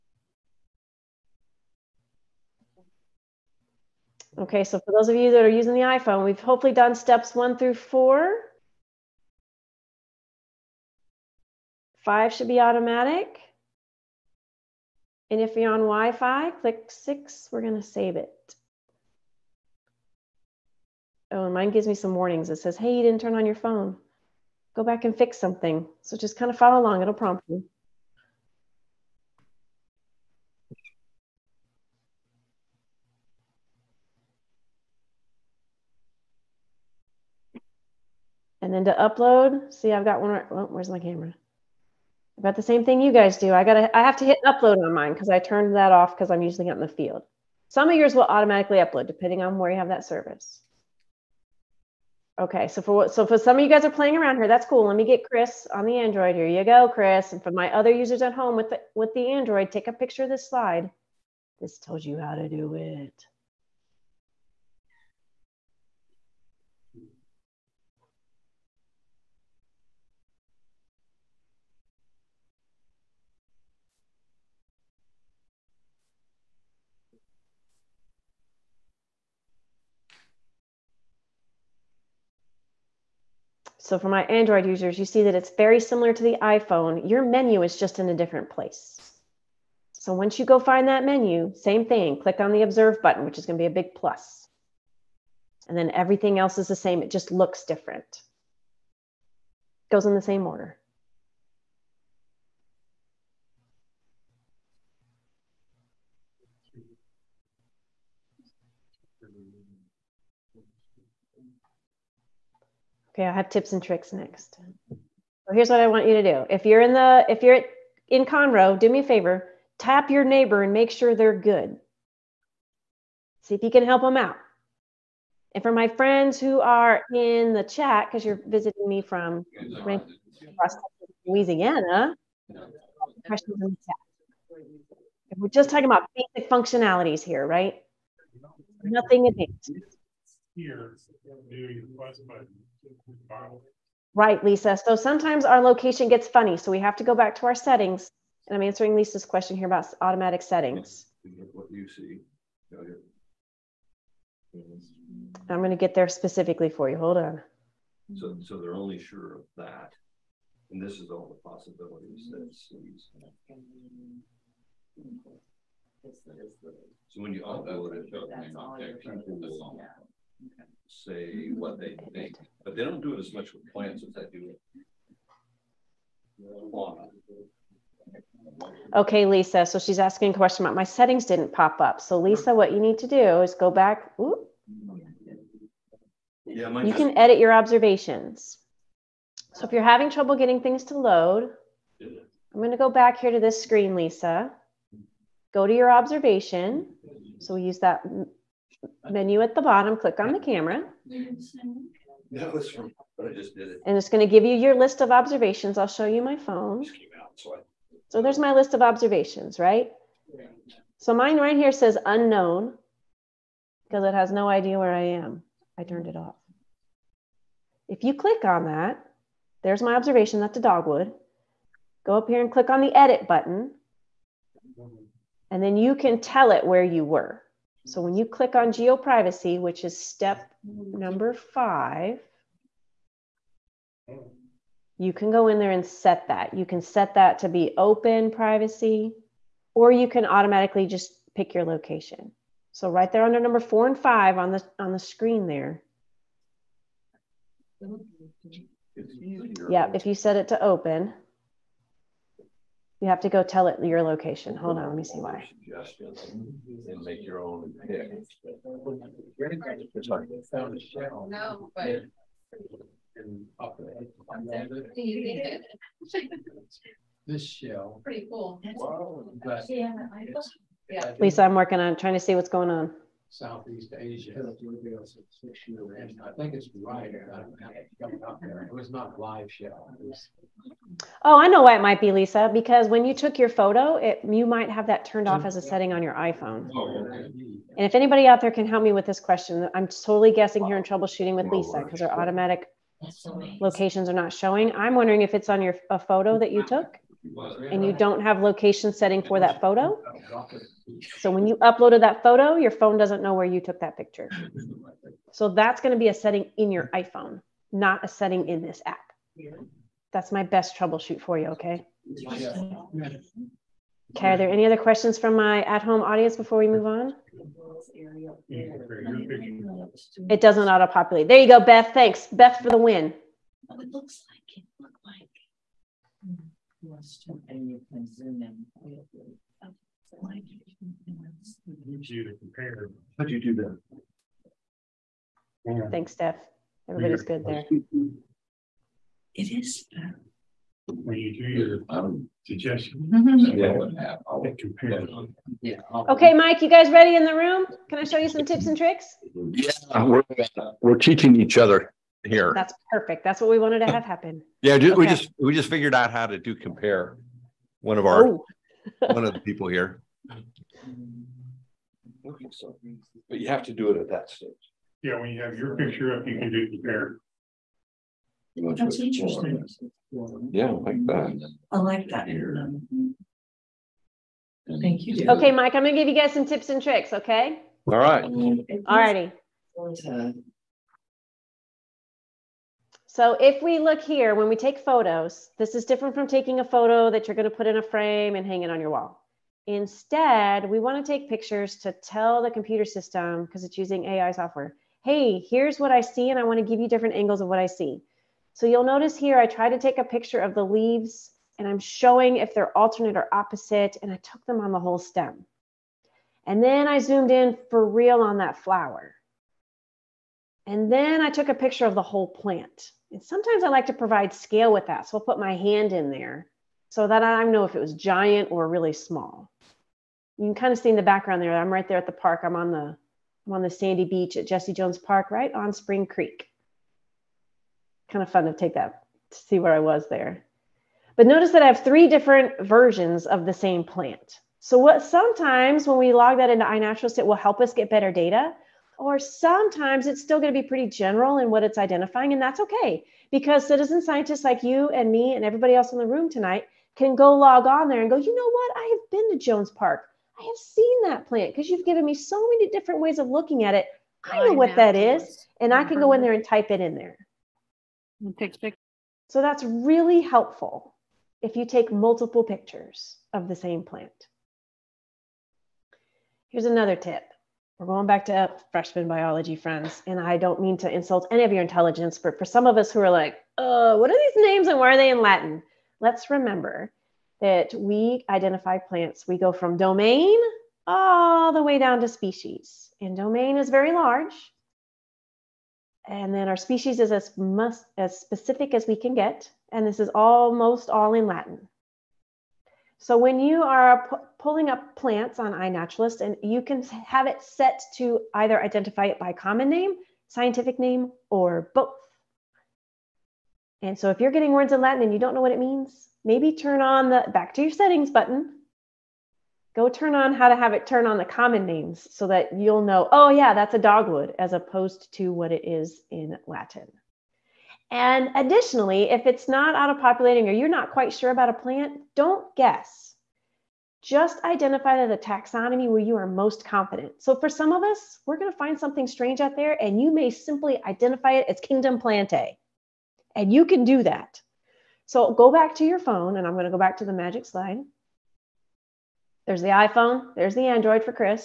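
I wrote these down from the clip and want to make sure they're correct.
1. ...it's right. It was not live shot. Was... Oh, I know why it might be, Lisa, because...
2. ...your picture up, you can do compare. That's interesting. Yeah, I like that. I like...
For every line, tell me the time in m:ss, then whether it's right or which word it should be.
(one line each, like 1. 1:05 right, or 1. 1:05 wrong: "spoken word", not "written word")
1. 4:36 right
2. 6:05 right.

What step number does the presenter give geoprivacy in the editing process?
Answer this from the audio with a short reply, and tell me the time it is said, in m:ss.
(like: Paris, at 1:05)
5, at 3:49.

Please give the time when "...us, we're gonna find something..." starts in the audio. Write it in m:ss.
8:47.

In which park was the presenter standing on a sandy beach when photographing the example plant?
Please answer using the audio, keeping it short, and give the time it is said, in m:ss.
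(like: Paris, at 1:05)
Jesse Jones Park, at 7:04.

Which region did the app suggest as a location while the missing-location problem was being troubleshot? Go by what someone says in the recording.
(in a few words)
Southeast Asia.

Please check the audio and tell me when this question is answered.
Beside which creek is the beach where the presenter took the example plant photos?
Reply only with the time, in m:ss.
7:05.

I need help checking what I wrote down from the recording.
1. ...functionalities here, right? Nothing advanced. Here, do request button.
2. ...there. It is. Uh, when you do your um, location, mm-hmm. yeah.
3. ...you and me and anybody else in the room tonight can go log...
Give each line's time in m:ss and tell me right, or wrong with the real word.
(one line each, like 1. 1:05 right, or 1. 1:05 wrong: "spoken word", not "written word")
1. 2:16 right
2. 5:37 wrong: "suggestion", not "location"
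3. 7:24 wrong: "everybody", not "anybody".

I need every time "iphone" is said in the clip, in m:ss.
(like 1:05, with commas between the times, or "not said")
0:05, 1:26, 4:46, 5:06, 8:59.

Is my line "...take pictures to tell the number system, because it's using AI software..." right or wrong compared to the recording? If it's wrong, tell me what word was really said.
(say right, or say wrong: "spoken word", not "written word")
wrong: "computer", not "number".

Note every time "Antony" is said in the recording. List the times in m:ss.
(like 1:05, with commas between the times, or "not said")
not said.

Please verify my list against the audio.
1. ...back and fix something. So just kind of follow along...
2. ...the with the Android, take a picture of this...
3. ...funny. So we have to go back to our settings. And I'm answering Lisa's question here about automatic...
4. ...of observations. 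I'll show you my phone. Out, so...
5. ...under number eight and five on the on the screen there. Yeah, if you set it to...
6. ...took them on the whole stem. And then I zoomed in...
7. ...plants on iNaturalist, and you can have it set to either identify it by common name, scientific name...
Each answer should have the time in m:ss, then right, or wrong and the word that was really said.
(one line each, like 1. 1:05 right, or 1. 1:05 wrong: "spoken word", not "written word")
1. 0:24 right
2. 0:58 right
3. 2:26 right
4. 3:25 right
5. 4:03 wrong: "four", not "eight"
6. 6:44 right
7. 8:14 right.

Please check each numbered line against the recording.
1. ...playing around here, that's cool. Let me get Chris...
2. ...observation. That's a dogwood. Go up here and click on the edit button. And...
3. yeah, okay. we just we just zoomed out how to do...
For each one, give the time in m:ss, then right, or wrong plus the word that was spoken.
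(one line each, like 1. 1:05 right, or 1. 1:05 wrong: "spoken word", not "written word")
1. 0:53 right
2. 3:39 right
3. 5:54 wrong: "figured", not "zoomed".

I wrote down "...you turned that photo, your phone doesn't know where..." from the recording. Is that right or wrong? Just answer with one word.
wrong.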